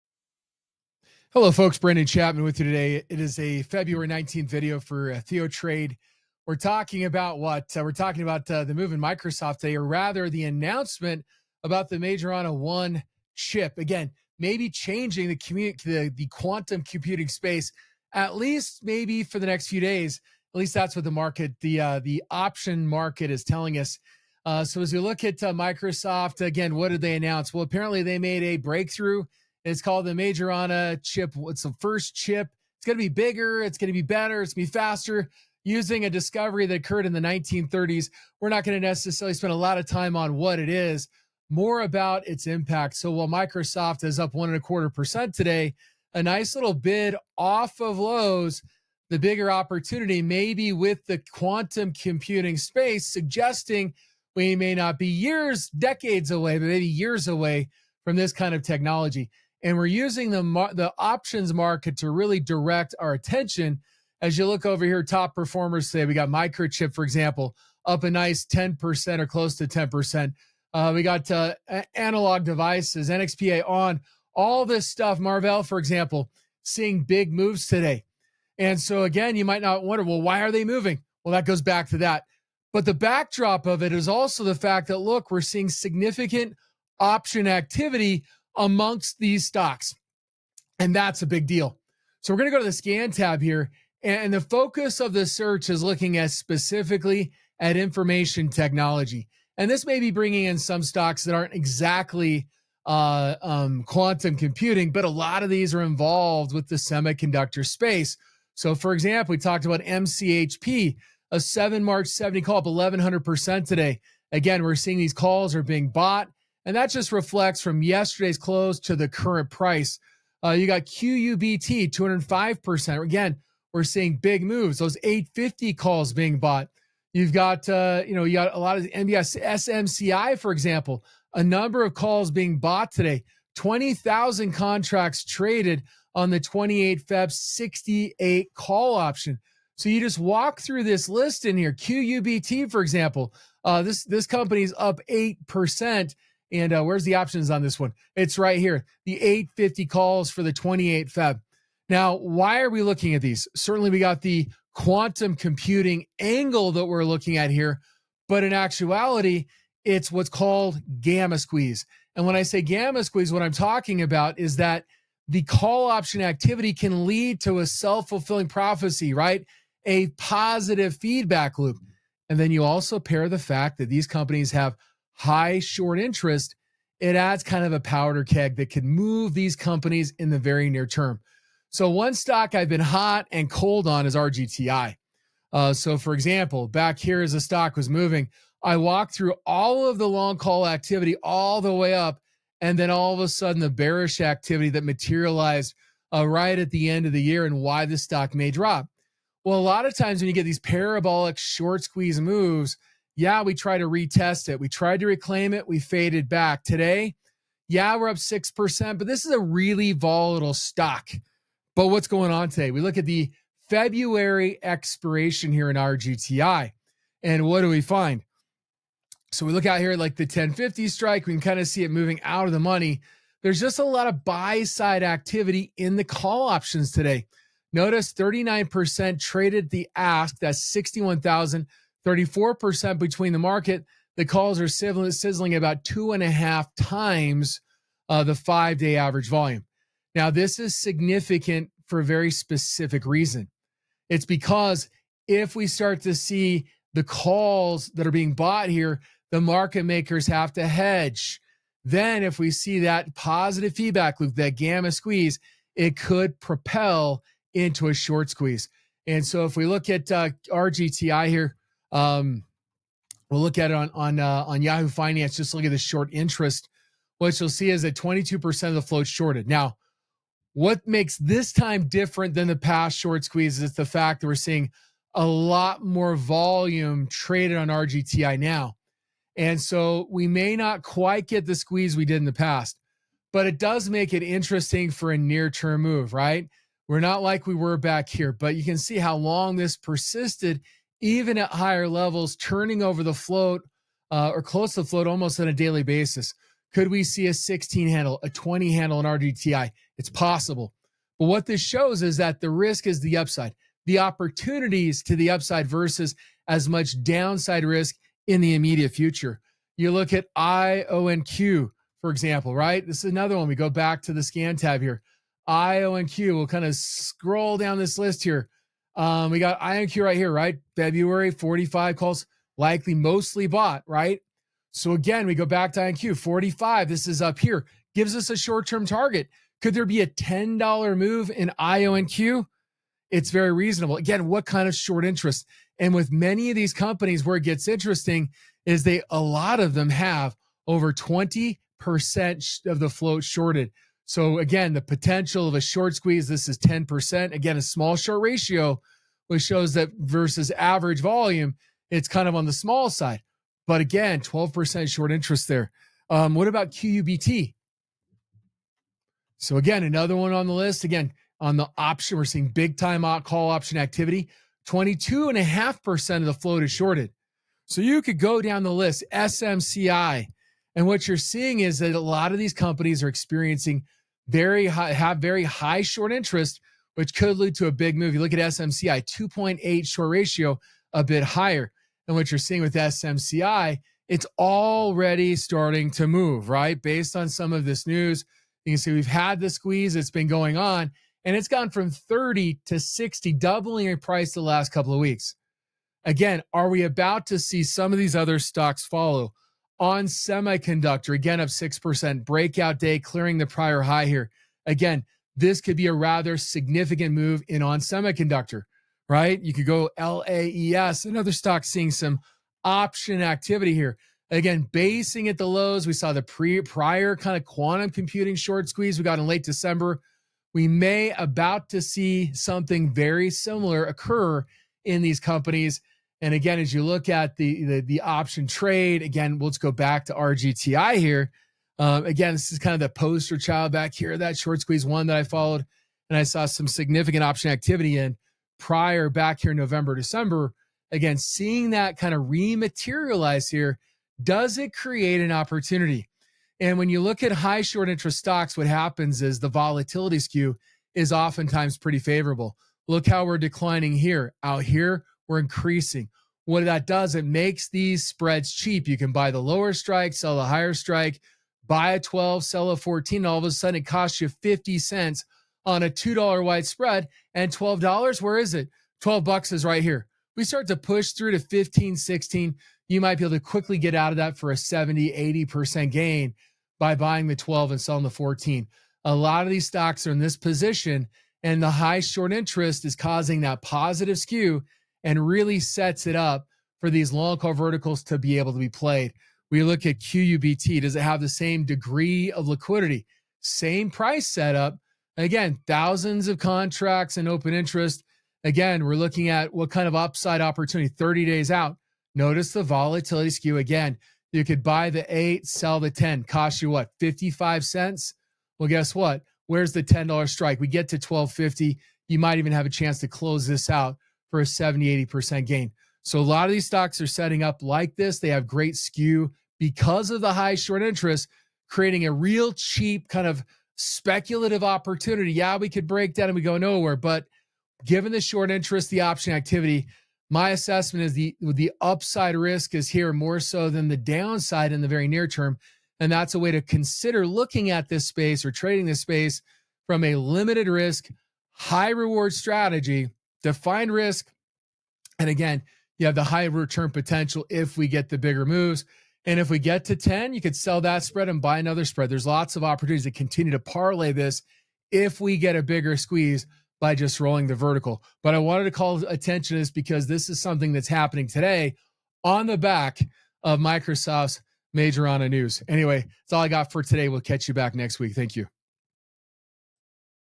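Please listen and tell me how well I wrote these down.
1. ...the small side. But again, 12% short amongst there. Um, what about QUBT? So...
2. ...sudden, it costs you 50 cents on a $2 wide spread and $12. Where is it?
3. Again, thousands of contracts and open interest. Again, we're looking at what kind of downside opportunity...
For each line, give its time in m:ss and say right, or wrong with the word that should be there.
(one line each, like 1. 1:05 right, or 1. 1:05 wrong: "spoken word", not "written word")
1. 5:52 wrong: "interest", not "amongst"
2. 7:43 right
3. 8:15 wrong: "upside", not "downside".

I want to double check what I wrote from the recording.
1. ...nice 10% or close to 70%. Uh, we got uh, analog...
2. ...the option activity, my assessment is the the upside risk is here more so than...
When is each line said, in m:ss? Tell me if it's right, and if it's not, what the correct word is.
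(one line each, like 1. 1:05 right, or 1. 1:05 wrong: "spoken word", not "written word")
1. 1:08 wrong: "10", not "70"
2. 8:48 right.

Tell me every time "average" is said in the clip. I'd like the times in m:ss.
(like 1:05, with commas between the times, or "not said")
3:58, 5:50.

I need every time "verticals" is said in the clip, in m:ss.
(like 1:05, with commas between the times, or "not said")
8:07, 9:17.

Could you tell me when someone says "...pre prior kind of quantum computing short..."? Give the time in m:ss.
6:56.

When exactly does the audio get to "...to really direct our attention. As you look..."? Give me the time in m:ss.
1:01.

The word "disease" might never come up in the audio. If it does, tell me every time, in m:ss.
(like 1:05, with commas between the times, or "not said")
not said.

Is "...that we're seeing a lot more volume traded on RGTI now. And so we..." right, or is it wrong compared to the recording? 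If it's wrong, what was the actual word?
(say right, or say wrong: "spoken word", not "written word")
right.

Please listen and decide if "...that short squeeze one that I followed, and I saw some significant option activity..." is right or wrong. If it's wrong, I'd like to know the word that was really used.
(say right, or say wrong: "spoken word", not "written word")
right.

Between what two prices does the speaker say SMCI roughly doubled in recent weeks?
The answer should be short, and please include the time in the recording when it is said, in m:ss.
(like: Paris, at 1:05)
30 to 60, at 6:31.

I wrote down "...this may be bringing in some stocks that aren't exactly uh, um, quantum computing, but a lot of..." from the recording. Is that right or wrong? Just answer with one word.
right.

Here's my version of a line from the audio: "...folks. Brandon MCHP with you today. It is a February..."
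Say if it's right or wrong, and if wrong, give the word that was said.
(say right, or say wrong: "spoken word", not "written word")
wrong: "Chapman", not "MCHP".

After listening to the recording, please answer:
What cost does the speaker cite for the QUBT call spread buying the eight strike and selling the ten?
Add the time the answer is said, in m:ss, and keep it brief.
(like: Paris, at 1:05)
55 cents, at 8:26.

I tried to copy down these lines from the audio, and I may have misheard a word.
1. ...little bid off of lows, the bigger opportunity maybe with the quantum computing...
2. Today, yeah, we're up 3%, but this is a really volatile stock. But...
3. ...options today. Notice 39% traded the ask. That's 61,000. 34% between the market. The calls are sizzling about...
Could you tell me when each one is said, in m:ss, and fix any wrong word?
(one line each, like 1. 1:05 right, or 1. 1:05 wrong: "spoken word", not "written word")
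1. 0:46 right
2. 3:26 wrong: "6", not "3"
3. 3:46 right.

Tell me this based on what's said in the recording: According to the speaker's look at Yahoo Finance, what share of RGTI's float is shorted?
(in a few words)
22%.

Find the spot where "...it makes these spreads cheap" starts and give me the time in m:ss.
7:37.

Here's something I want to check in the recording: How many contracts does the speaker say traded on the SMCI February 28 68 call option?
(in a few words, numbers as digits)
20,000.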